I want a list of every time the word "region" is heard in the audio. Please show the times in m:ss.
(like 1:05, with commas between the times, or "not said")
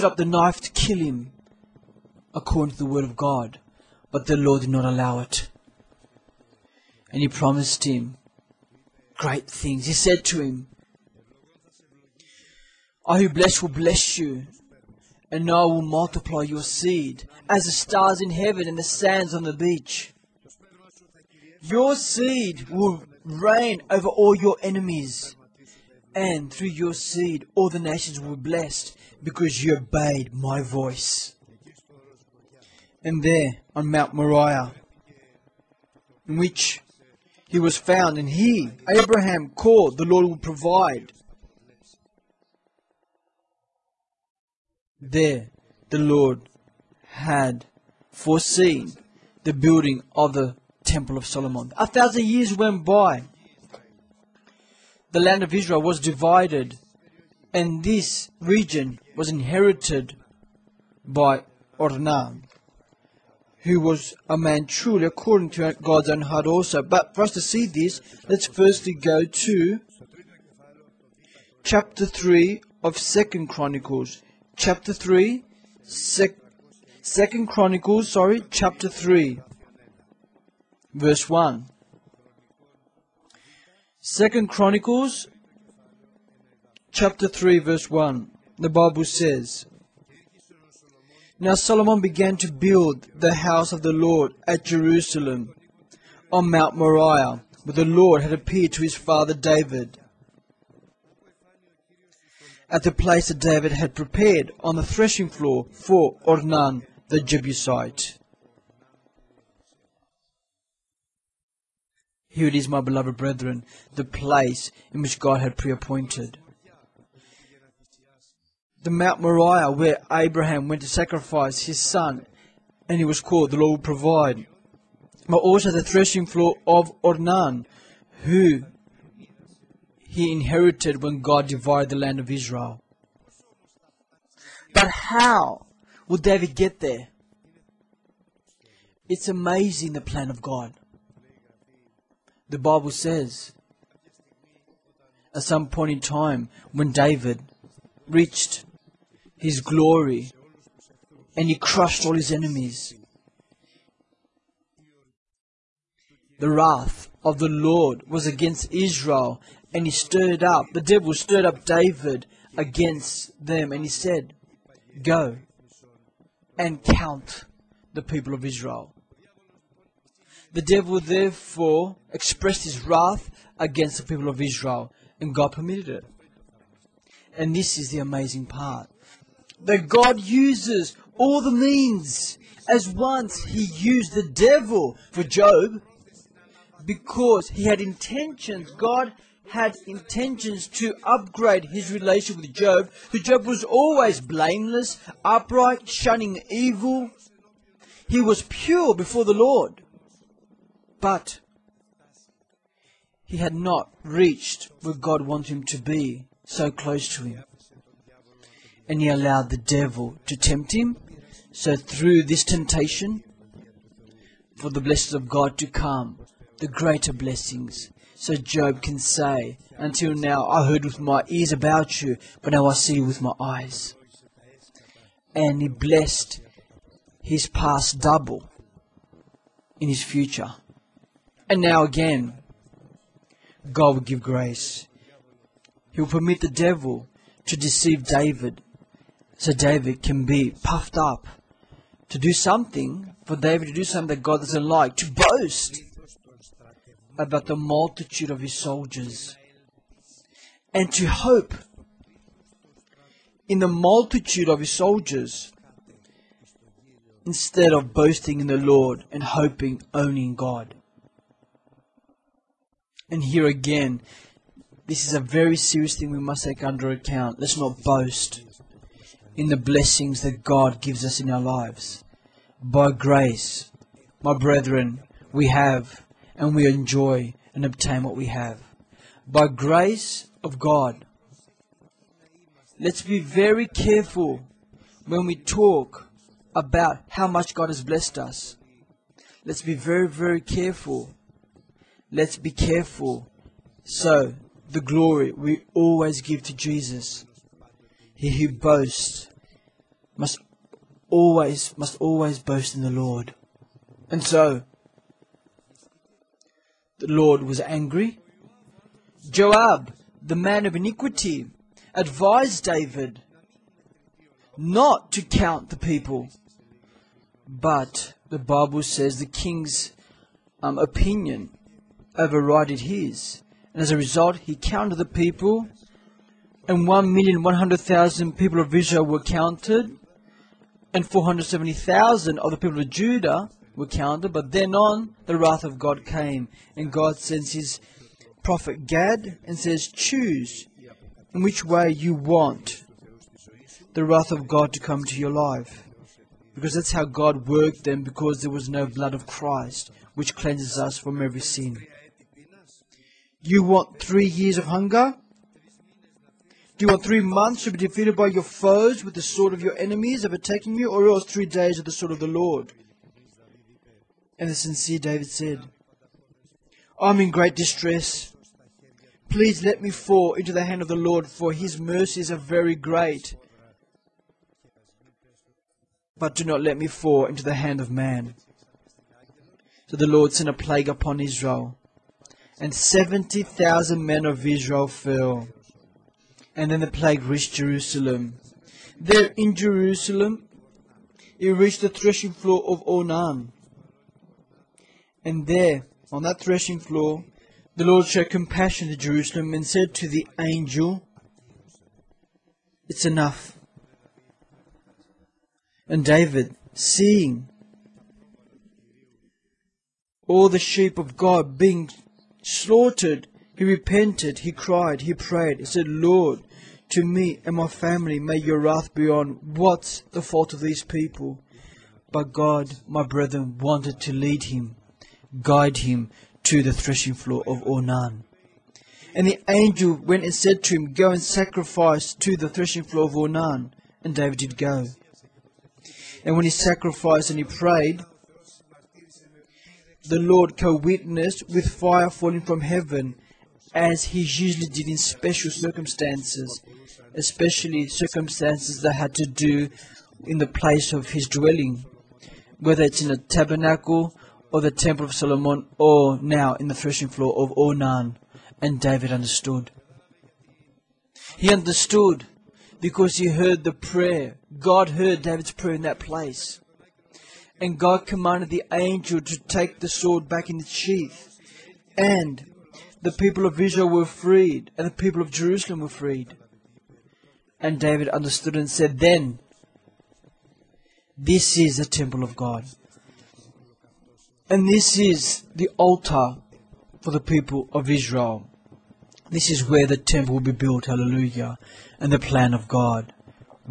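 0:58.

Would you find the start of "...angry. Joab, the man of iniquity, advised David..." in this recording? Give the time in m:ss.
5:07.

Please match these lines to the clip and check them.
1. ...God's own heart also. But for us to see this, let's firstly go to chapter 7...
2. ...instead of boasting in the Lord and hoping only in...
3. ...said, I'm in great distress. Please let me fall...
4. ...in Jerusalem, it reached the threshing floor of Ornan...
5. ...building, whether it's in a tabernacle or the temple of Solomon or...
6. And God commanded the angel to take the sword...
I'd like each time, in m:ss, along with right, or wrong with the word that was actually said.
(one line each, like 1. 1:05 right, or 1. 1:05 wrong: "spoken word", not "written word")
1. 1:05 wrong: "3", not "7"
2. 4:17 right
3. 6:05 right
4. 6:29 right
5. 7:31 wrong: "dwelling", not "building"
6. 7:47 right.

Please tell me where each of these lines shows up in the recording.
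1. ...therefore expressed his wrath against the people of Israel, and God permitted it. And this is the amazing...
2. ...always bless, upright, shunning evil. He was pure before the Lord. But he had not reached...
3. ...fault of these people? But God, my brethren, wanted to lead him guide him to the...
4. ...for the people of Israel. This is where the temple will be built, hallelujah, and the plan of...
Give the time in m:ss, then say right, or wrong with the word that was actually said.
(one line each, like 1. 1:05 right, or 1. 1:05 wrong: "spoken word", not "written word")
1. 2:51 right
2. 3:13 wrong: "blameless", not "bless"
3. 7:00 right
4. 8:07 right.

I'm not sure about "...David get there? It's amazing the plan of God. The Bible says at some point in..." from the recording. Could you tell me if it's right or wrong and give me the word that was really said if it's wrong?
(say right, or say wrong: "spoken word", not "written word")
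right.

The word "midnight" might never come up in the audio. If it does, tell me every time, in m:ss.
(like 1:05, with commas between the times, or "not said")
not said.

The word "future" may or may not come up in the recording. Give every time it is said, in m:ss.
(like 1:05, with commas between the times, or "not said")
3:50.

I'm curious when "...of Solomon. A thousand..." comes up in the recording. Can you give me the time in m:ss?
0:51.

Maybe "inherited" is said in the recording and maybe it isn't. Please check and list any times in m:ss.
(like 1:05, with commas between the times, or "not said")
0:59, 2:10.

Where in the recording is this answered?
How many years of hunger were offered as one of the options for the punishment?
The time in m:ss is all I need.
5:53.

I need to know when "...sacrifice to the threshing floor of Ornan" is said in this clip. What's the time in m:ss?
7:11.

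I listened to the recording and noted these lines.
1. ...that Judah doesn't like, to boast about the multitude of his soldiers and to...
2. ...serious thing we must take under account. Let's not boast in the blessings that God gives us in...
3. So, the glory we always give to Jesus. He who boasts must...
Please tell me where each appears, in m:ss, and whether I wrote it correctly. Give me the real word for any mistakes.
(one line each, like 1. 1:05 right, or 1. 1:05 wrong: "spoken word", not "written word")
1. 4:04 wrong: "God", not "Judah"
2. 4:25 right
3. 4:53 right.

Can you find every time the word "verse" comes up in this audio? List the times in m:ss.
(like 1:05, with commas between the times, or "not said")
1:20, 1:27.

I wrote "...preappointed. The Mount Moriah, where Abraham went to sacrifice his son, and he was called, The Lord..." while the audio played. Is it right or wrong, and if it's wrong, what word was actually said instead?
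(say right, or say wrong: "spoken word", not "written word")
right.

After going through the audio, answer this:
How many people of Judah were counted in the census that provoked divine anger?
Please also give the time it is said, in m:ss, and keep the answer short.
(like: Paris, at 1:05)
470,000, at 5:31.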